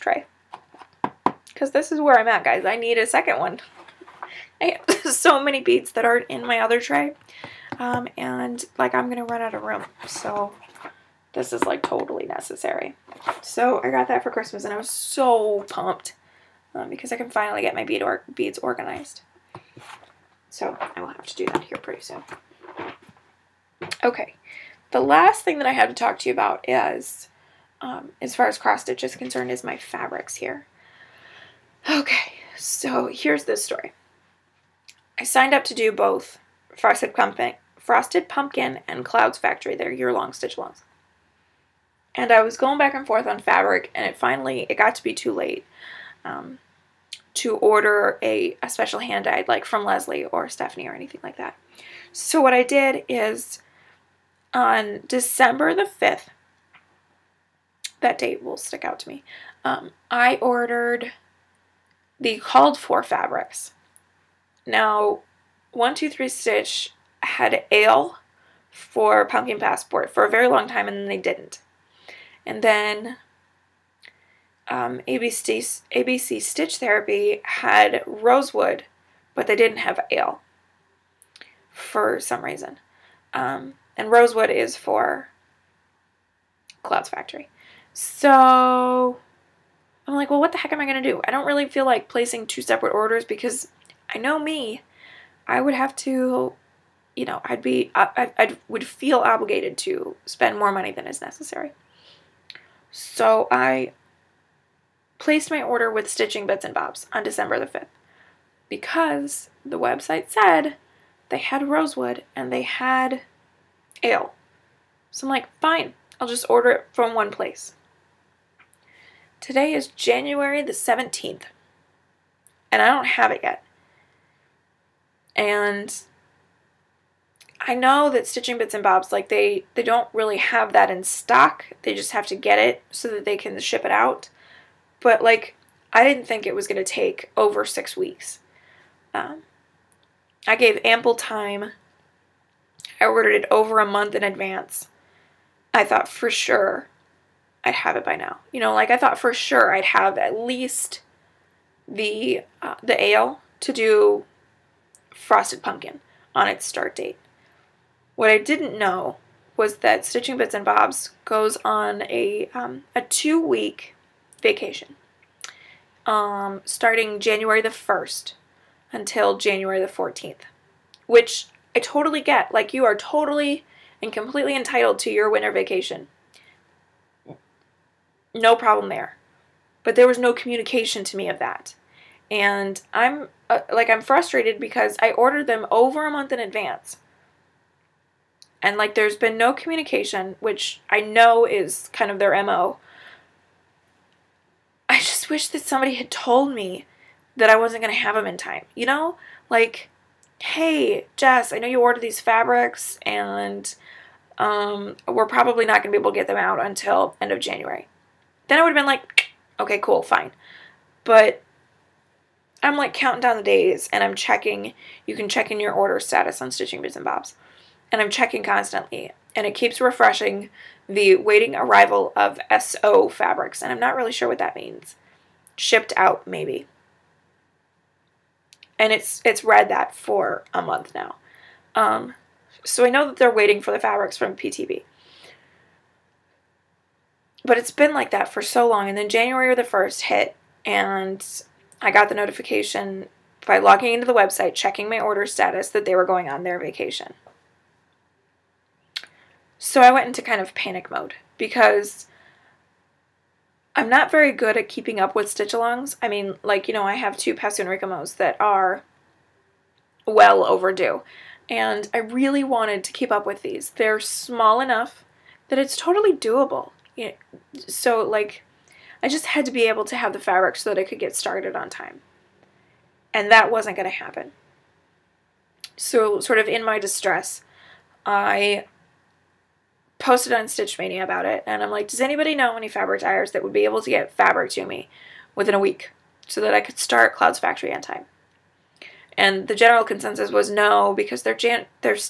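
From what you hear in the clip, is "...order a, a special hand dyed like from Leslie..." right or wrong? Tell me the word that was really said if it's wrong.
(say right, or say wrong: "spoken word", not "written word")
right.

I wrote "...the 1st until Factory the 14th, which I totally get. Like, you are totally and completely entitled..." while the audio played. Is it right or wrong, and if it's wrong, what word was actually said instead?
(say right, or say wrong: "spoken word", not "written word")
wrong: "January", not "Factory".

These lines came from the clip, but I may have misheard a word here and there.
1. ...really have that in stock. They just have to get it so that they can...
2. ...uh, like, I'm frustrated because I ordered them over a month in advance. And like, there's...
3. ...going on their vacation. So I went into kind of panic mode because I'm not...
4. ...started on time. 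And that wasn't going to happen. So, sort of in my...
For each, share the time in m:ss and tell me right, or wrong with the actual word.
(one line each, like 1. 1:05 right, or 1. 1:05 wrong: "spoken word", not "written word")
1. 2:10 right
2. 3:03 right
3. 4:06 right
4. 4:31 right.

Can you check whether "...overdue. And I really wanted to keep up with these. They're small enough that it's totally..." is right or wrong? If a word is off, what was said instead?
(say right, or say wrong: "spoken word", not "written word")
right.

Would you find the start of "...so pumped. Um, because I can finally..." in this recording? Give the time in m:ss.
0:14.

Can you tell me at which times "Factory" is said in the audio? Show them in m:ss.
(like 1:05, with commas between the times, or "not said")
0:39, 1:27, 4:47.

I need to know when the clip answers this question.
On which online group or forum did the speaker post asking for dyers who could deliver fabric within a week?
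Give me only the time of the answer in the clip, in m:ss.
4:40.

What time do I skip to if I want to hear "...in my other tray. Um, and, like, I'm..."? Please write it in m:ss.
0:06.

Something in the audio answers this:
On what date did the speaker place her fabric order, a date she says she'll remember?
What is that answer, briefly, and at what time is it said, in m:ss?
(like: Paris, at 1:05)
December 5th, at 0:55.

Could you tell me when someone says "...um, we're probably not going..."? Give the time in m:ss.
3:24.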